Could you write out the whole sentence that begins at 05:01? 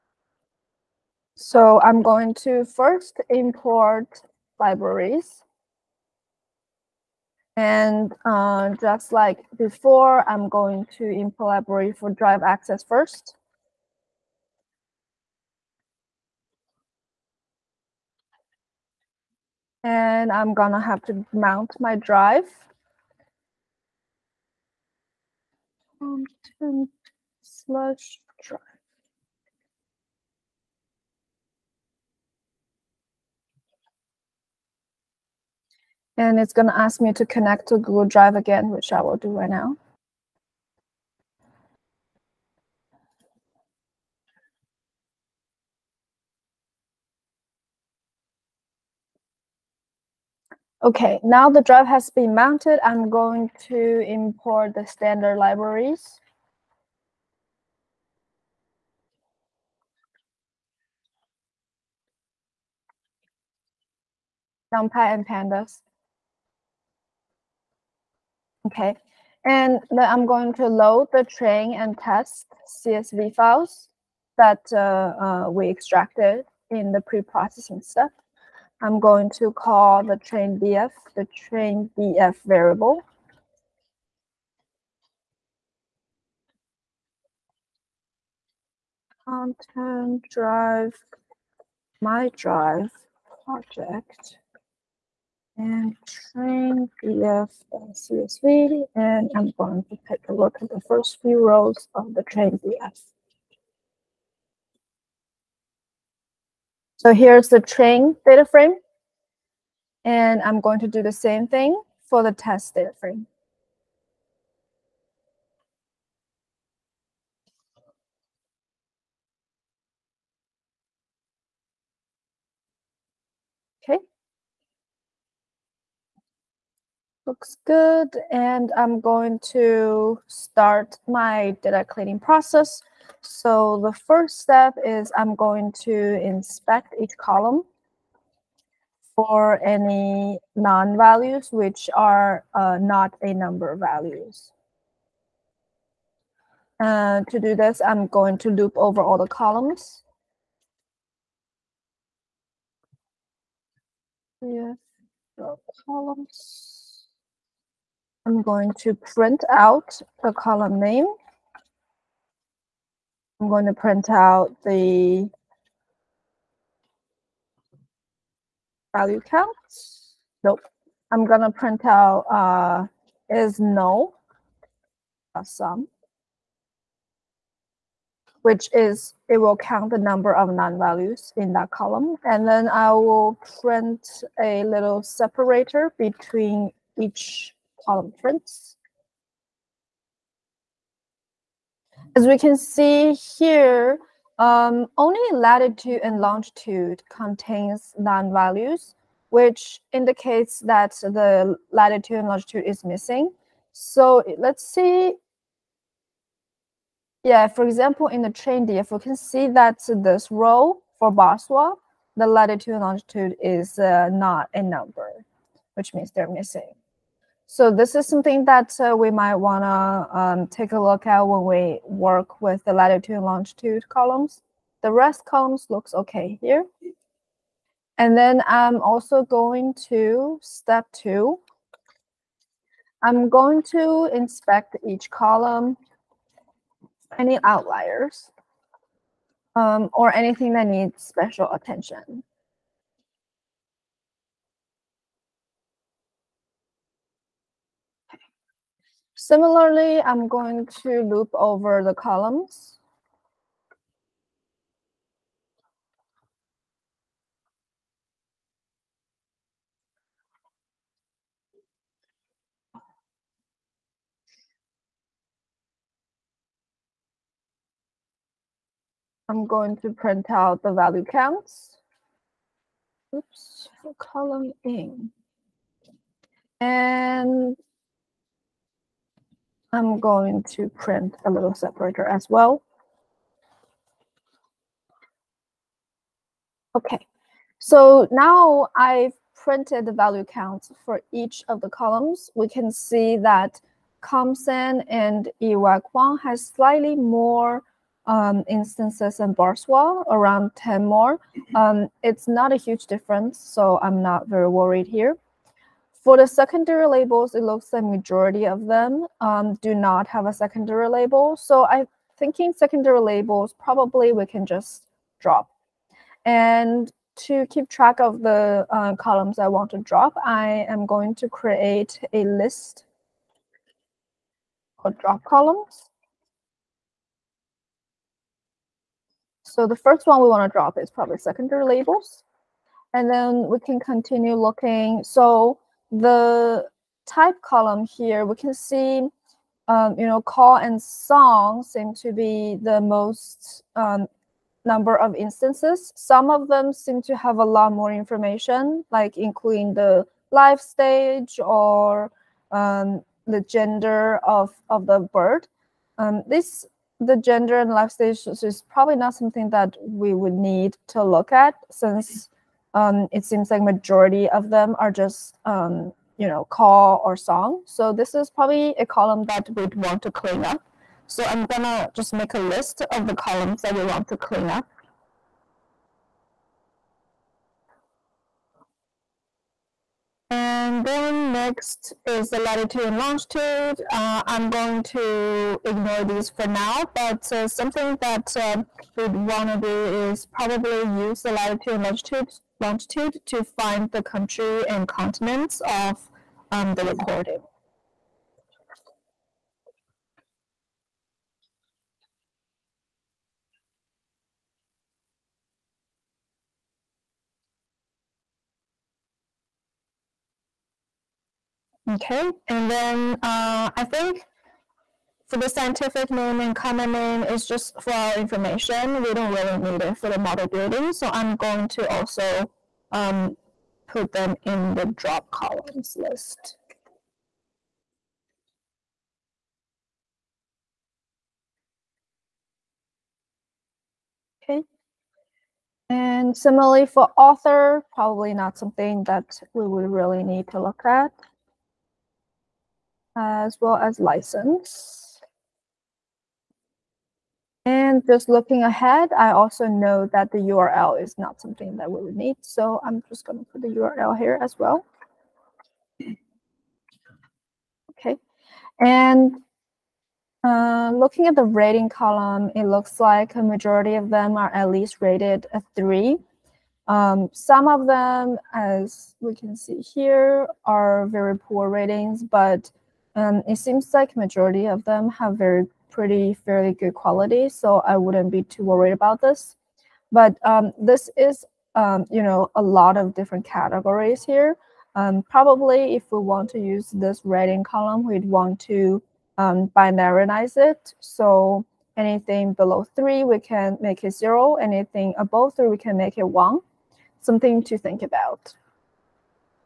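Um, it's not a huge difference, so I'm not very worried here.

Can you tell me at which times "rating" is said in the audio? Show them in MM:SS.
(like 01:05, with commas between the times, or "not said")
07:41, 07:51, 08:07.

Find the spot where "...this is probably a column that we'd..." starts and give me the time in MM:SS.
06:07.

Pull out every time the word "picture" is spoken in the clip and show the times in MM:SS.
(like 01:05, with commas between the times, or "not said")
not said.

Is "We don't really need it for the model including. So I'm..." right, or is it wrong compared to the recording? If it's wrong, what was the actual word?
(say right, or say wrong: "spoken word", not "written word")
wrong: "building", not "including".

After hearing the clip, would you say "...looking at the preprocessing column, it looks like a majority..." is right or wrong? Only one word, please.
wrong.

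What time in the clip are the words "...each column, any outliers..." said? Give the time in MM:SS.
03:54.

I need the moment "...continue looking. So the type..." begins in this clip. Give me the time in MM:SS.
05:33.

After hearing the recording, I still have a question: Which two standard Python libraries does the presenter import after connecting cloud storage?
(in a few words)
NumPy and pandas.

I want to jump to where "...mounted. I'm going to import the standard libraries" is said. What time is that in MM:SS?
00:52.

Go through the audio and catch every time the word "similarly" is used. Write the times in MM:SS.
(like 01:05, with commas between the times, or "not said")
04:09, 07:16.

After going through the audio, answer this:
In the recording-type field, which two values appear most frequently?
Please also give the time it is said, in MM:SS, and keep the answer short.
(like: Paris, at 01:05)
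call and song, at 05:40.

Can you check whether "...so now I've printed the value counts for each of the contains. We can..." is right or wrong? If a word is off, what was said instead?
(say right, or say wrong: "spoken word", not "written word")
wrong: "columns", not "contains".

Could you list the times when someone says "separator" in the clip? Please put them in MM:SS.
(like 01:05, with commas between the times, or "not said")
03:05, 04:41.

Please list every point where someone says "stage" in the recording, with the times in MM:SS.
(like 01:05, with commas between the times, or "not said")
05:50, 05:57.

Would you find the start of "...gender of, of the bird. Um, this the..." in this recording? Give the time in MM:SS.
05:53.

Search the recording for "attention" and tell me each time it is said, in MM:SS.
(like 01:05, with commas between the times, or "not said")
04:01.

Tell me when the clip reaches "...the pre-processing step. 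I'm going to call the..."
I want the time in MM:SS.
01:16.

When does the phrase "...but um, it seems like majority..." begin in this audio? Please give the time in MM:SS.
07:52.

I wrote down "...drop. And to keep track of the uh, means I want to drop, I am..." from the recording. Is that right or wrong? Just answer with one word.
wrong.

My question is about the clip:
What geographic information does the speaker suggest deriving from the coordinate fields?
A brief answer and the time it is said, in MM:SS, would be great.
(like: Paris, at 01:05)
country and continents, at 06:34.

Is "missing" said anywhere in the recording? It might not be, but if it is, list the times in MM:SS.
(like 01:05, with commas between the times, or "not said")
03:22, 03:36.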